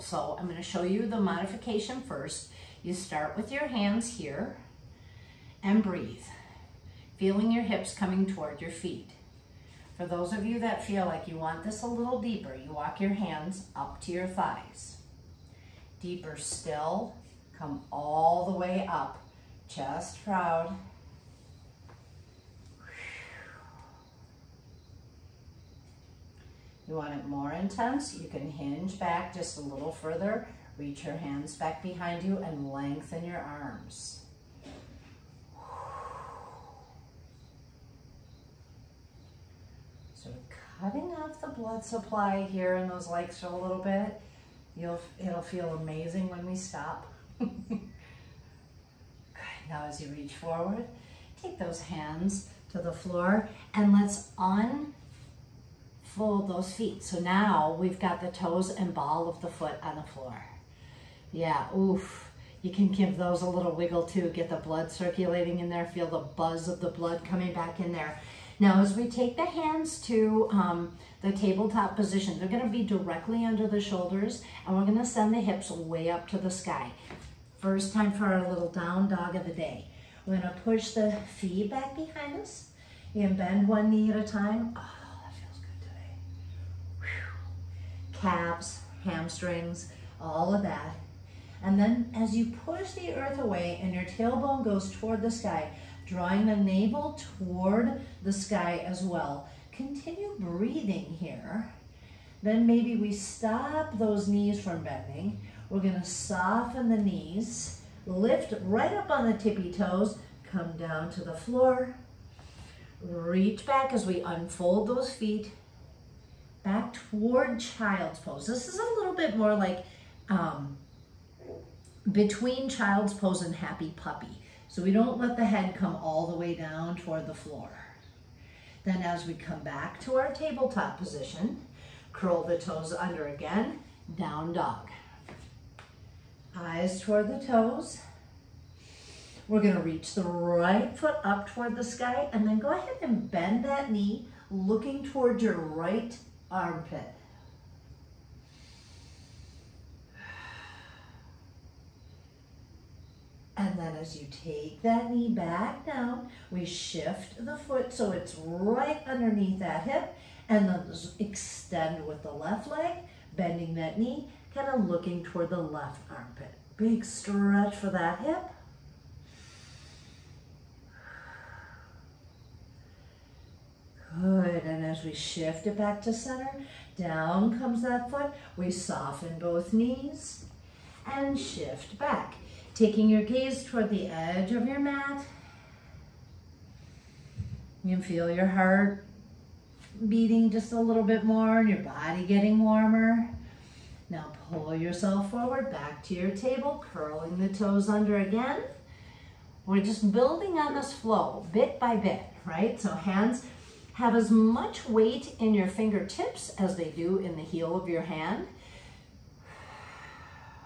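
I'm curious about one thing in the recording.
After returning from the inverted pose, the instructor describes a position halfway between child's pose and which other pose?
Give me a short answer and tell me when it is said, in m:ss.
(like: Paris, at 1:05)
Happy puppy, at 2:03.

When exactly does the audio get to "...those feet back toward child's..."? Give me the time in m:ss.
1:54.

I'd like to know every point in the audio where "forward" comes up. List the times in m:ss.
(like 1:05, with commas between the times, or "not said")
0:50, 3:15.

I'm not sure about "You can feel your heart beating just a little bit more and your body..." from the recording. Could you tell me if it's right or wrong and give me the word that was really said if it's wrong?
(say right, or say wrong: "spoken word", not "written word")
right.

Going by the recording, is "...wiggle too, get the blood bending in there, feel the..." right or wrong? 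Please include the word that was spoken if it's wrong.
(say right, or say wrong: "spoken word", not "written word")
wrong: "circulating", not "bending".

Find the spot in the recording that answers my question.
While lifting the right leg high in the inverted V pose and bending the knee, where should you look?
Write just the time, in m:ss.
2:25.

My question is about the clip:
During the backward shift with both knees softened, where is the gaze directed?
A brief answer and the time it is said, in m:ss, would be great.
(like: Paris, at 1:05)
Edge of your mat, at 3:04.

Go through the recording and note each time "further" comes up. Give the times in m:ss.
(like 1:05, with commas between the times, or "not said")
0:29.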